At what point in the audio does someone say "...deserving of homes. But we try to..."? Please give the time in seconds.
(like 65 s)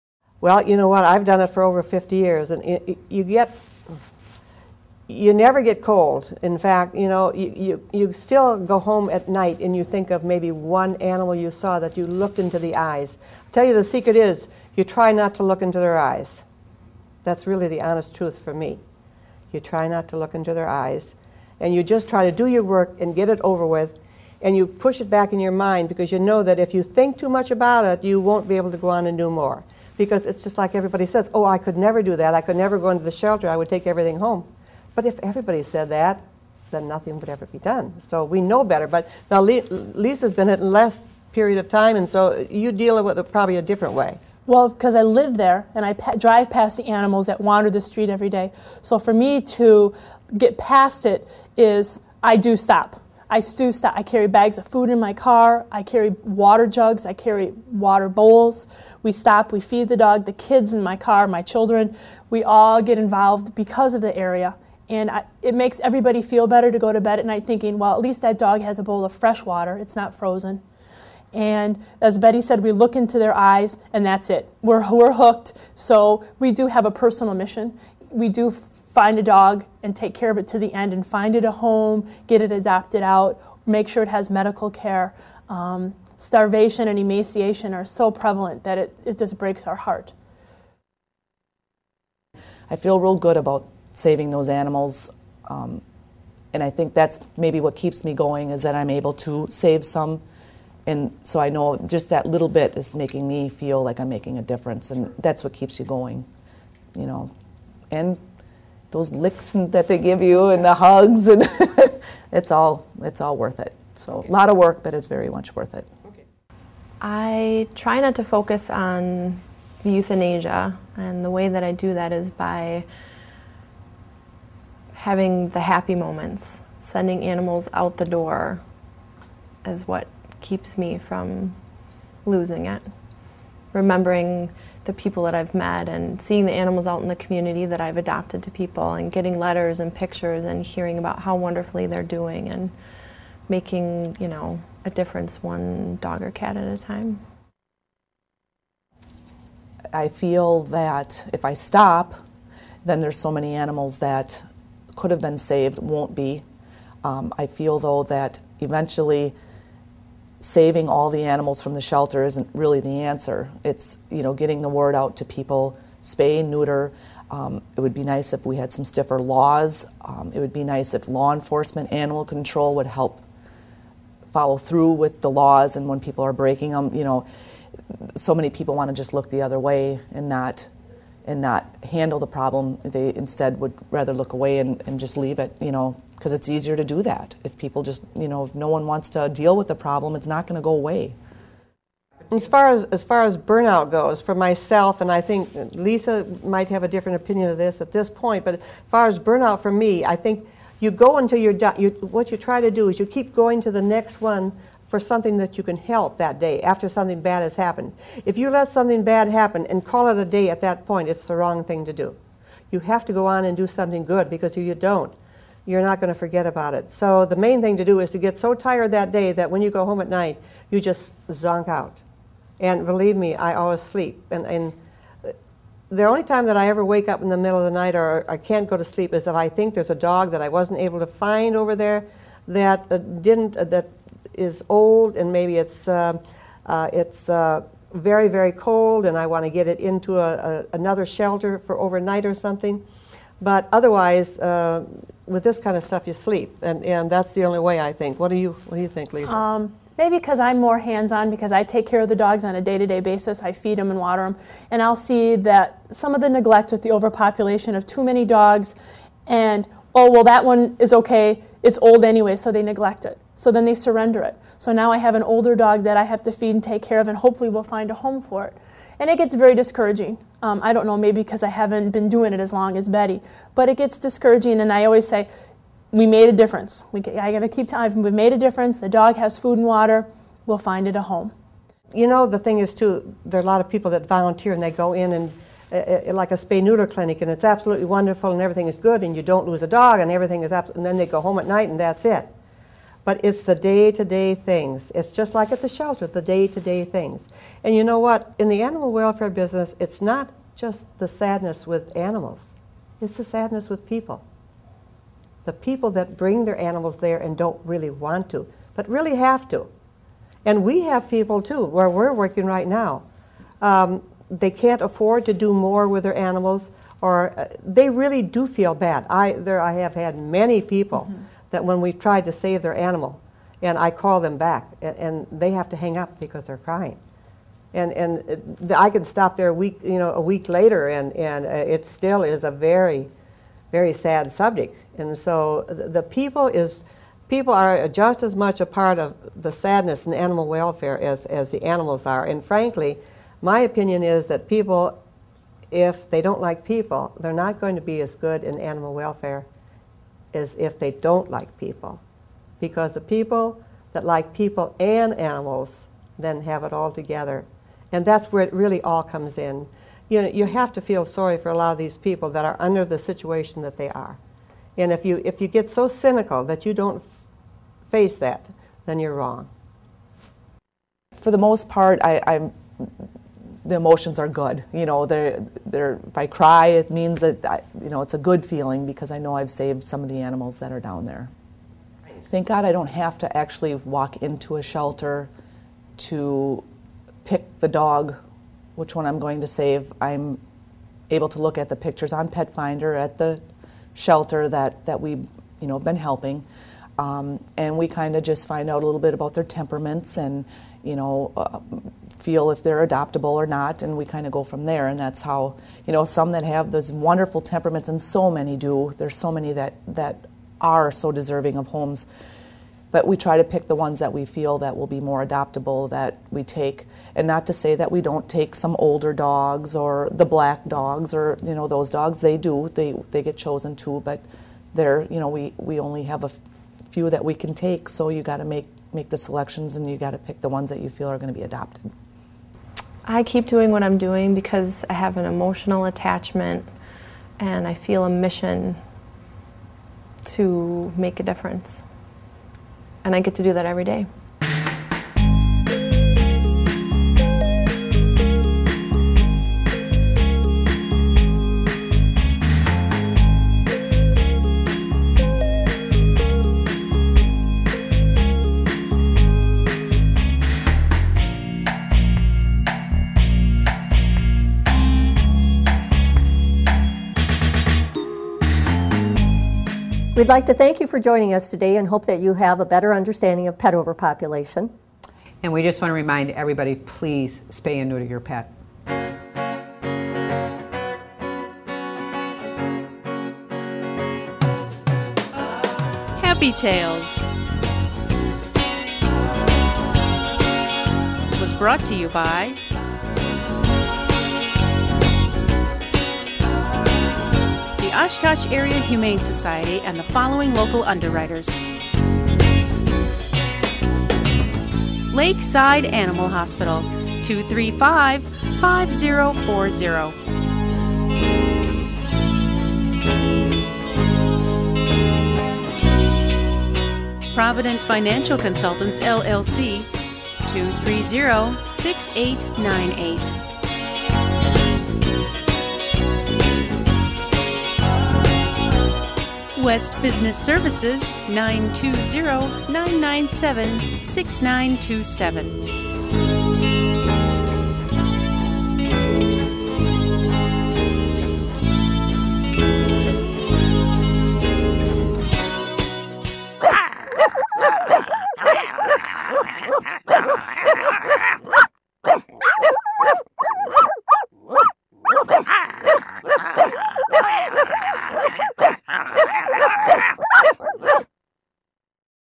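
411 s.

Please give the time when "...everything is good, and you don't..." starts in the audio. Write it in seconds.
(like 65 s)
288 s.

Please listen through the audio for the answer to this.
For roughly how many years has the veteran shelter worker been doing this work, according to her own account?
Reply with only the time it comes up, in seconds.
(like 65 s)
1 s.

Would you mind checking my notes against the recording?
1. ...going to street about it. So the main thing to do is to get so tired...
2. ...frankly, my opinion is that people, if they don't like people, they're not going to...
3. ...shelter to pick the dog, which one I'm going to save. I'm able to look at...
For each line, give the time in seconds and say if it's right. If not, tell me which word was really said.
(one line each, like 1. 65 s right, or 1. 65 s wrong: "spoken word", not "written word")
1. 216 s wrong: "forget", not "street"
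2. 342 s right
3. 384 s right.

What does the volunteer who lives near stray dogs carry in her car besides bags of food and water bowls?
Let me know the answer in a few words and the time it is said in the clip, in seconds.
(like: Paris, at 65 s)
water jugs, at 56 s.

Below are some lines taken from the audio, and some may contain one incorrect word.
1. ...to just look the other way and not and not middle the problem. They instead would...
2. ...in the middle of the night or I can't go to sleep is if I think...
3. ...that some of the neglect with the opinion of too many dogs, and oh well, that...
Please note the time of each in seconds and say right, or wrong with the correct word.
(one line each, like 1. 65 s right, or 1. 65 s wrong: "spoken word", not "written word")
1. 178 s wrong: "handle", not "middle"
2. 227 s right
3. 255 s wrong: "overpopulation", not "opinion".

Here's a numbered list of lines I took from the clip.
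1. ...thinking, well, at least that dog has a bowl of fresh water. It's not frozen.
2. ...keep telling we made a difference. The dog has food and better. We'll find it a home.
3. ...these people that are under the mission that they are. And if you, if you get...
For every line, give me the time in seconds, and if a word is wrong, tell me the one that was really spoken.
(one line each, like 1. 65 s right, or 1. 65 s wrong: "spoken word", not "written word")
1. 67 s right
2. 277 s wrong: "water", not "better"
3. 361 s wrong: "situation", not "mission".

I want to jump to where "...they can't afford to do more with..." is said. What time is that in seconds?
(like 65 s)
314 s.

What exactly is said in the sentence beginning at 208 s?
If you let something bad happen and call it a day at that point, it's the wrong thing to do.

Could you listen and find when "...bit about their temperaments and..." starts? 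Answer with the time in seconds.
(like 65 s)
398 s.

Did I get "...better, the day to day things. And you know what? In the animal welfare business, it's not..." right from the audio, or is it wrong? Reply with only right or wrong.
wrong.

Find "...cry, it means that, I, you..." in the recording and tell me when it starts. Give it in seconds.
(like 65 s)
376 s.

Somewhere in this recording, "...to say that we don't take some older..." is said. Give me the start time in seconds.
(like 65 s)
417 s.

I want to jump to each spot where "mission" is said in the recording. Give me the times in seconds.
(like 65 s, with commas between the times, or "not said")
77 s, 438 s.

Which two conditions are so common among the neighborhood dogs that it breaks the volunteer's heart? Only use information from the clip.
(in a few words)
starvation and emaciation.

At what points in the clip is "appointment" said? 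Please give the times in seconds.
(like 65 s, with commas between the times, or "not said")
not said.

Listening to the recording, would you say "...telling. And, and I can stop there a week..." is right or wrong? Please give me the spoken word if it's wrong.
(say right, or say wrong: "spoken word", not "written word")
wrong: "crying", not "telling".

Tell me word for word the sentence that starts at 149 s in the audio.
I feel that if I stop, then there's so many animals that could have been saved, won't be.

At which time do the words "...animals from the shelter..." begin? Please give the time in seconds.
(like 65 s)
161 s.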